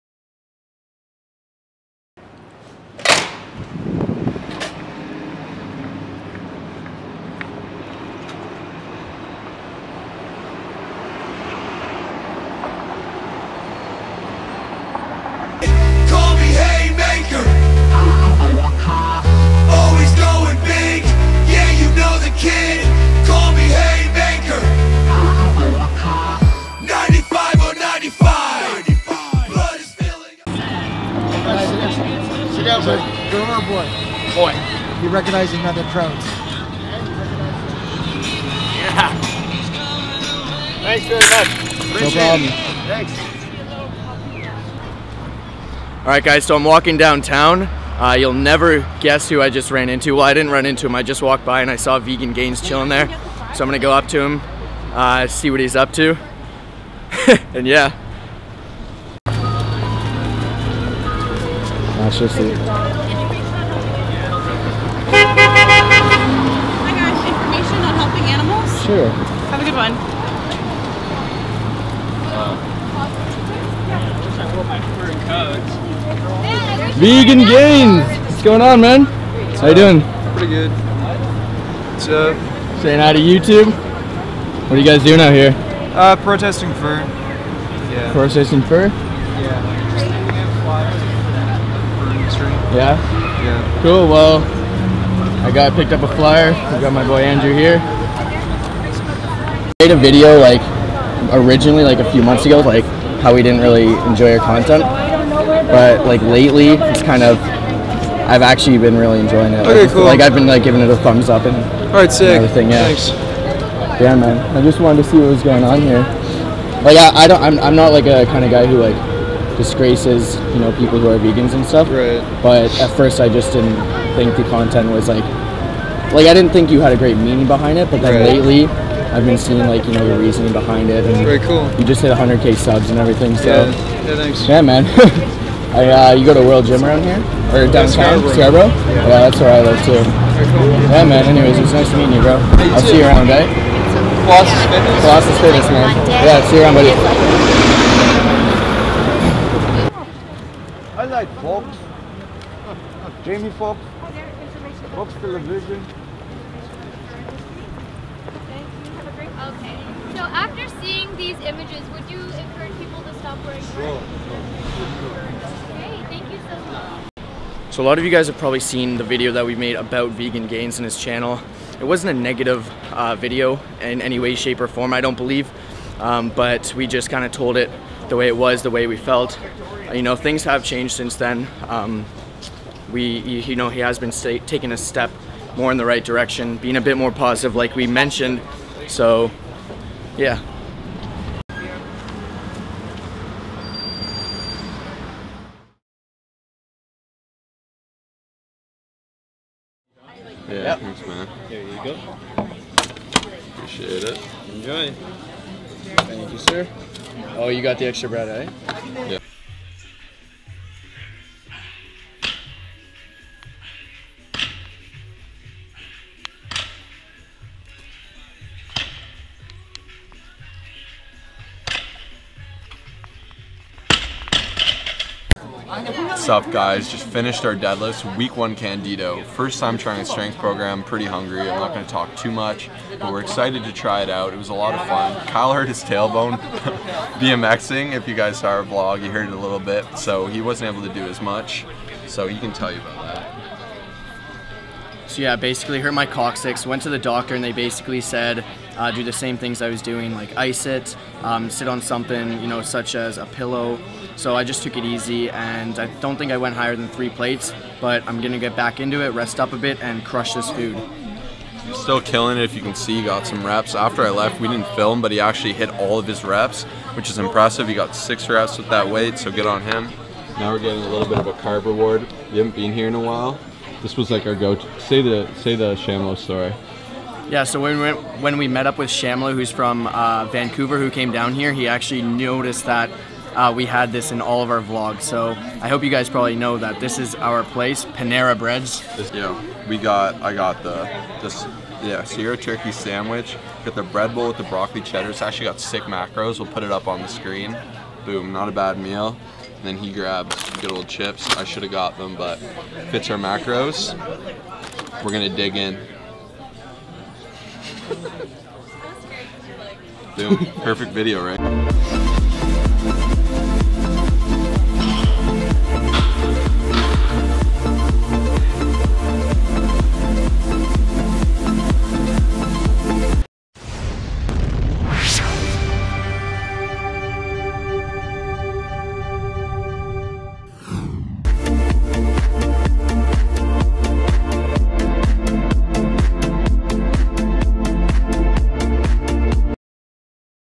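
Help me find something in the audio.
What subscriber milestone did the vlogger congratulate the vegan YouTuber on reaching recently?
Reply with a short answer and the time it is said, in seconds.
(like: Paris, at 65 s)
100k, at 132 s.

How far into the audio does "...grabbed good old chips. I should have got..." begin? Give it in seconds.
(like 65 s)
299 s.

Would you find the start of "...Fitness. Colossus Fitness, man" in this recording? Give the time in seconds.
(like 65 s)
144 s.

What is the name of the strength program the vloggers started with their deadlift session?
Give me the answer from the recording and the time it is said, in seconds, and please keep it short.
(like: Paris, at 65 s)
Candito, at 228 s.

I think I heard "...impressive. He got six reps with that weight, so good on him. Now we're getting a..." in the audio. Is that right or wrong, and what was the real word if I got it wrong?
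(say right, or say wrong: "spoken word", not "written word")
right.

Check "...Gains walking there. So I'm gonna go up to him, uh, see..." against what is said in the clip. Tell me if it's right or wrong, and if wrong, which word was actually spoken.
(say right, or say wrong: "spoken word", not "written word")
wrong: "chilling", not "walking".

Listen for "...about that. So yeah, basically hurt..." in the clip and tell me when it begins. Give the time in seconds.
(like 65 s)
242 s.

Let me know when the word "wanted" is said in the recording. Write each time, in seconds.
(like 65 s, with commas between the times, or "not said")
114 s.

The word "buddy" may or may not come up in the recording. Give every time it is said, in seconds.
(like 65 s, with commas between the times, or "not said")
32 s, 146 s.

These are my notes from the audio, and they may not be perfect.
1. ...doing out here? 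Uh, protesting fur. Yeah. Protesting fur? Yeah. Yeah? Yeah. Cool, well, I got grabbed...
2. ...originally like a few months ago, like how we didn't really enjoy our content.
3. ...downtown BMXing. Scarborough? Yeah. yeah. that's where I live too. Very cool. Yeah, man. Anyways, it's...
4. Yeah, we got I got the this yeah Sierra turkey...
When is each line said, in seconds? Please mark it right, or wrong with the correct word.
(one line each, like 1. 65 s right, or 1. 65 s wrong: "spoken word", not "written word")
1. 85 s wrong: "picked", not "grabbed"
2. 101 s right
3. 137 s wrong: "Scarborough", not "BMXing"
4. 289 s right.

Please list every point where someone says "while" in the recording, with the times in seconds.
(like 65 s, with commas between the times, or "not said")
272 s.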